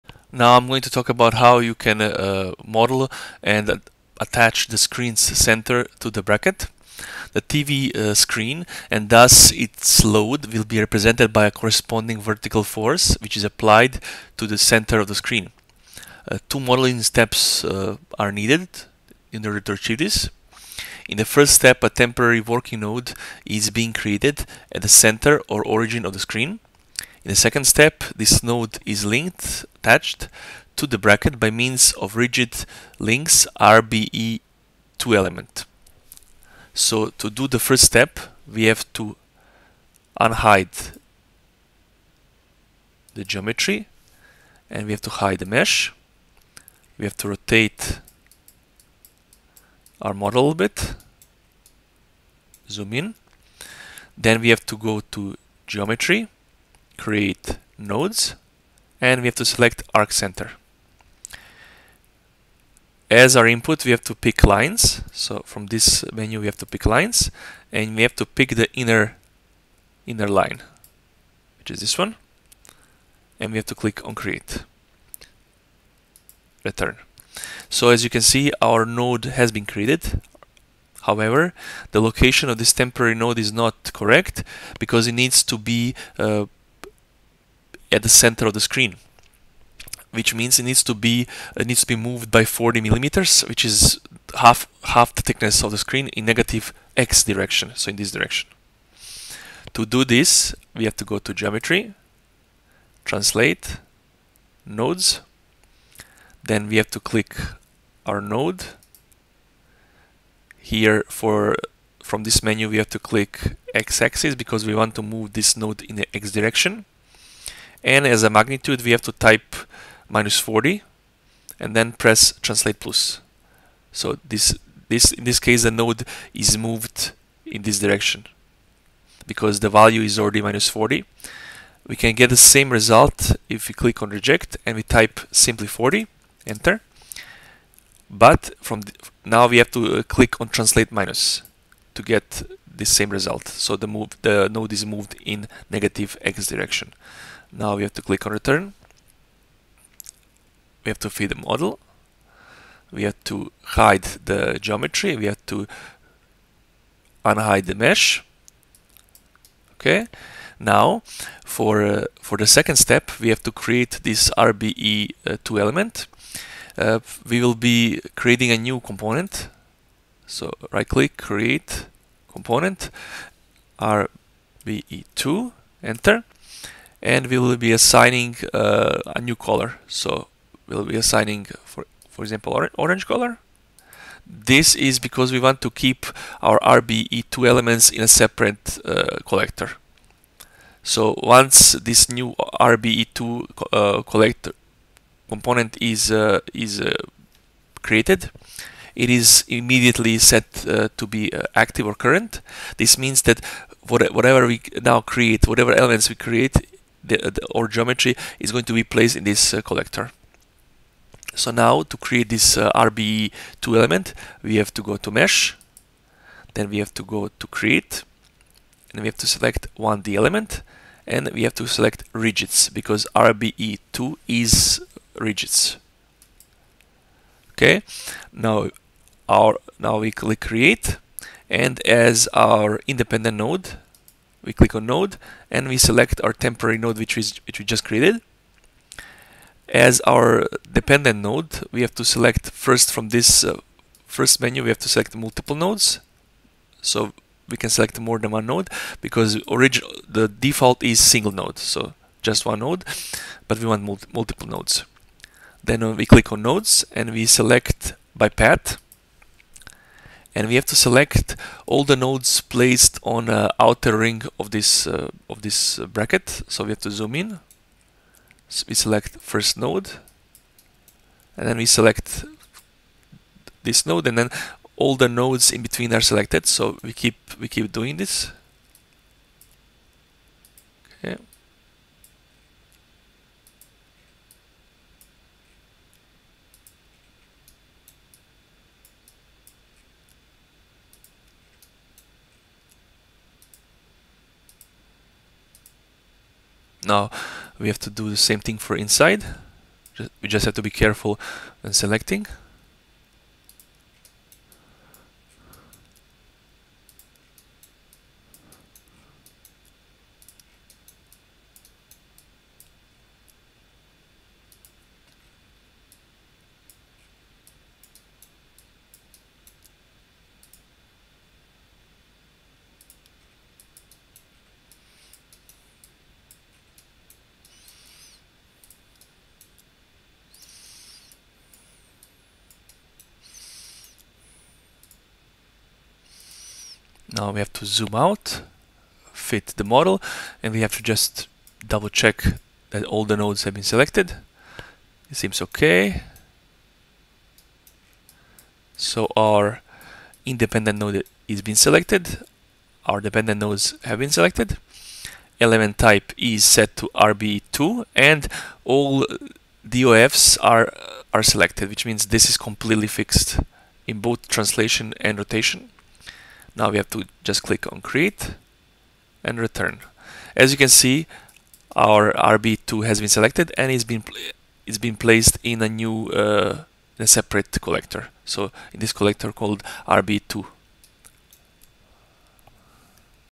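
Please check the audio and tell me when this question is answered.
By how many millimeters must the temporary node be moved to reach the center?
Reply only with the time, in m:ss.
1:32.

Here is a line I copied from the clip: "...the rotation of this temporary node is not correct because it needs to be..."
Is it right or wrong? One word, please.
wrong.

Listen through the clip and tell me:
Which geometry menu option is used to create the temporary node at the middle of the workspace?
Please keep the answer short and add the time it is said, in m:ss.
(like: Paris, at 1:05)
arc center, at 0:59.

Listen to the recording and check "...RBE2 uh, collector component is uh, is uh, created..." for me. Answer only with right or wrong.
right.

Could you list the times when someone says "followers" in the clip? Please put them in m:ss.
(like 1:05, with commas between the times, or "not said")
not said.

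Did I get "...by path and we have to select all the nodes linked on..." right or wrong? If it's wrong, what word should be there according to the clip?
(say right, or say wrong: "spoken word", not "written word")
wrong: "placed", not "linked".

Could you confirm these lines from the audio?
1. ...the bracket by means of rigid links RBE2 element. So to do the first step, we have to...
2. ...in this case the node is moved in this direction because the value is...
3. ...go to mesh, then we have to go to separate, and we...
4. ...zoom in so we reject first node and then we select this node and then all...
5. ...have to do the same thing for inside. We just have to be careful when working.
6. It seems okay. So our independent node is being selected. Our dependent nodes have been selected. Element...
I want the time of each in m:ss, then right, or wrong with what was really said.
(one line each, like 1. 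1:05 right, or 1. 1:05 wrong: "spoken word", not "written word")
1. 0:30 right
2. 2:05 right
3. 3:34 wrong: "create", not "separate"
4. 4:26 wrong: "select", not "reject"
5. 4:57 wrong: "selecting", not "working"
6. 5:45 right.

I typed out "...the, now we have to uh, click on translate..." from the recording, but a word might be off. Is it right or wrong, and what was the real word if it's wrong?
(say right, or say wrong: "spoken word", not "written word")
right.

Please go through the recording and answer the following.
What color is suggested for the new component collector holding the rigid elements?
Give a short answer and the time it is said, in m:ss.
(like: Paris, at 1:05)
orange, at 3:02.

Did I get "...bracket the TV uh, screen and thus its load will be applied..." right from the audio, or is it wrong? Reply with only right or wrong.
wrong.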